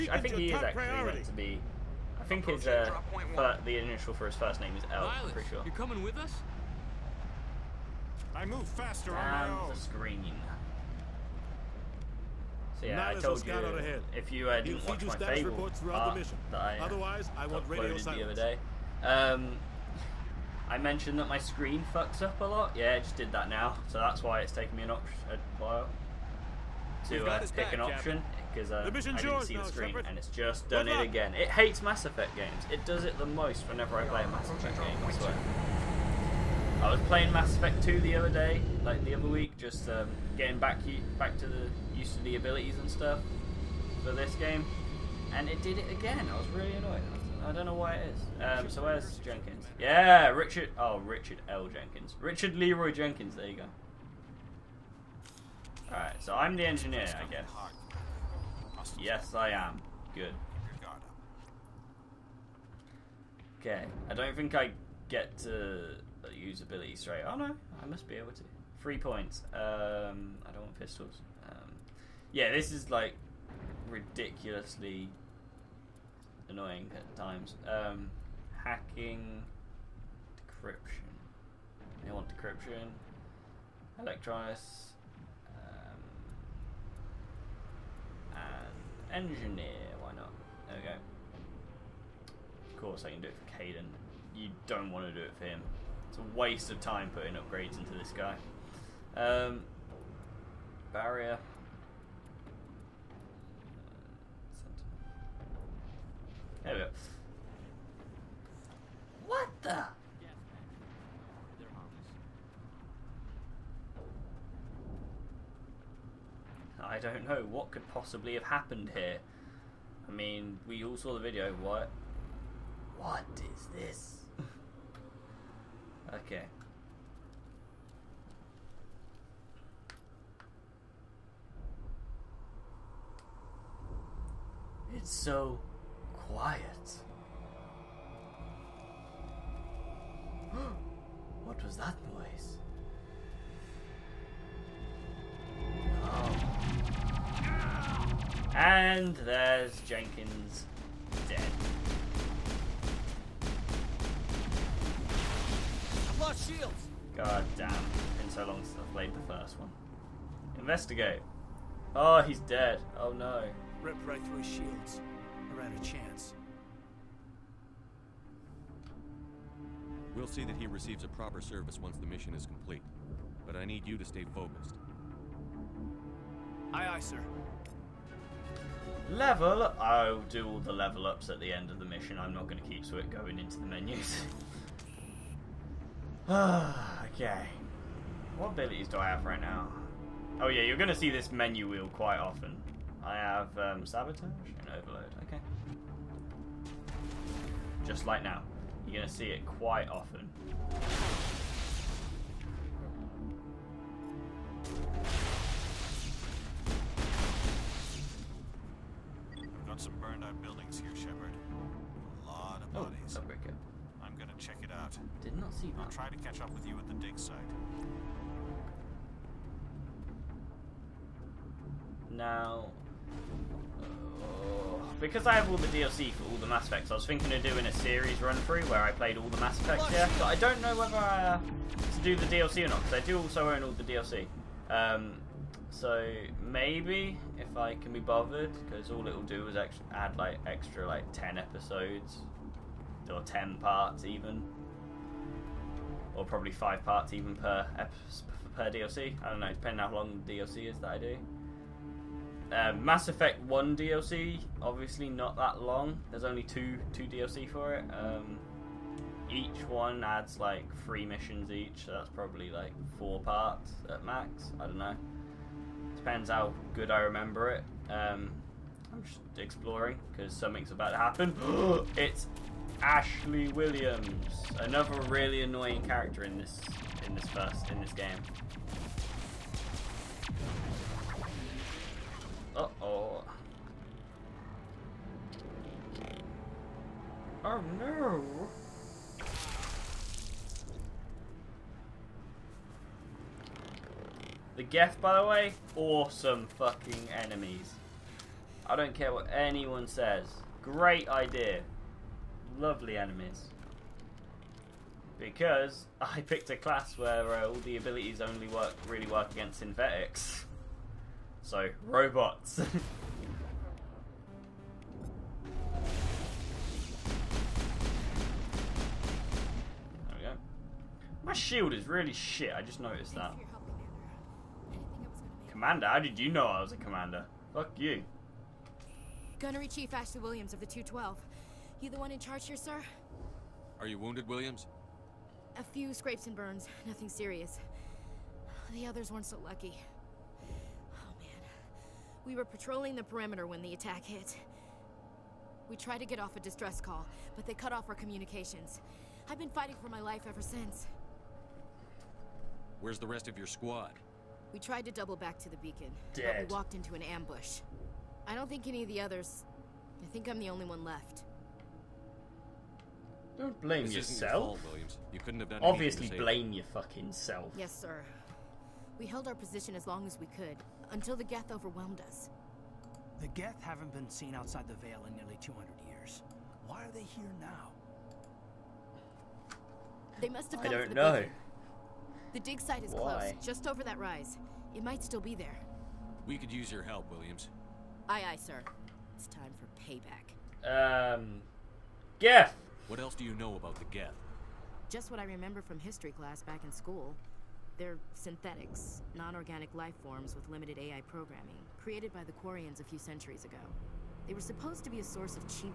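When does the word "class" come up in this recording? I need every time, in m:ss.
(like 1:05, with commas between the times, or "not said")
5:06, 6:36.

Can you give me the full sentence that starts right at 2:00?
I mean, we all saw the video.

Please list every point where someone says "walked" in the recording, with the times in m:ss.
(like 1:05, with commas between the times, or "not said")
5:56.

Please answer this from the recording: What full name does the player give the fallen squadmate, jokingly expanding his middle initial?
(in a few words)
Richard Leroy Jenkins.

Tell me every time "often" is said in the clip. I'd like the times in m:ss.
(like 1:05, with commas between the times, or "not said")
3:12, 3:19.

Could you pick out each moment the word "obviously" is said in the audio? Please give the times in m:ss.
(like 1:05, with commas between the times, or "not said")
4:14, 6:05.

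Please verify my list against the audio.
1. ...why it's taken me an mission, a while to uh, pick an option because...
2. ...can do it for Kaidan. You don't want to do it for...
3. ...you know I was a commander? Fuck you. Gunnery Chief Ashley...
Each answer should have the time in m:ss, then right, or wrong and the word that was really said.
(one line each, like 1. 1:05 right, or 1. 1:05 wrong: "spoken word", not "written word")
1. 0:24 wrong: "option", not "mission"
2. 1:33 right
3. 5:26 right.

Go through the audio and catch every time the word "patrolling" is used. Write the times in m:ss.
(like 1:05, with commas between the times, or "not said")
5:42.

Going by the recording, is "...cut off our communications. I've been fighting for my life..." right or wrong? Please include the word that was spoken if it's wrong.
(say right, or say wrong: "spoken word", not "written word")
right.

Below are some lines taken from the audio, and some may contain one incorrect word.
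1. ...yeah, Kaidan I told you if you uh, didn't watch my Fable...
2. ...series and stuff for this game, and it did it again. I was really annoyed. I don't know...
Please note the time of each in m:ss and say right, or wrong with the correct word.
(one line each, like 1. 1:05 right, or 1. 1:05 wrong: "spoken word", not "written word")
1. 0:12 wrong: "Not", not "Kaidan"
2. 0:42 wrong: "abilities", not "series".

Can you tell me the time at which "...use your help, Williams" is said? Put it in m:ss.
6:26.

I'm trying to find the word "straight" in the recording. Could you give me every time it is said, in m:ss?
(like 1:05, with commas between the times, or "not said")
1:06.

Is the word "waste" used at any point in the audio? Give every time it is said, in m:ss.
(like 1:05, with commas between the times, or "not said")
1:36.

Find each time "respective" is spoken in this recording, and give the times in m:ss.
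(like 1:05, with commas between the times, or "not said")
not said.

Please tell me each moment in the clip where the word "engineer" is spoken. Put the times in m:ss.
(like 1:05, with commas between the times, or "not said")
0:56, 1:29.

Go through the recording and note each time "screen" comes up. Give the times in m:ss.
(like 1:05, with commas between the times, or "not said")
0:09, 0:21, 0:29.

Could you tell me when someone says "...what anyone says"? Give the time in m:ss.
4:59.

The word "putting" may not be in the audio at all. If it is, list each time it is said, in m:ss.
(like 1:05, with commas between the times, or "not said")
1:37.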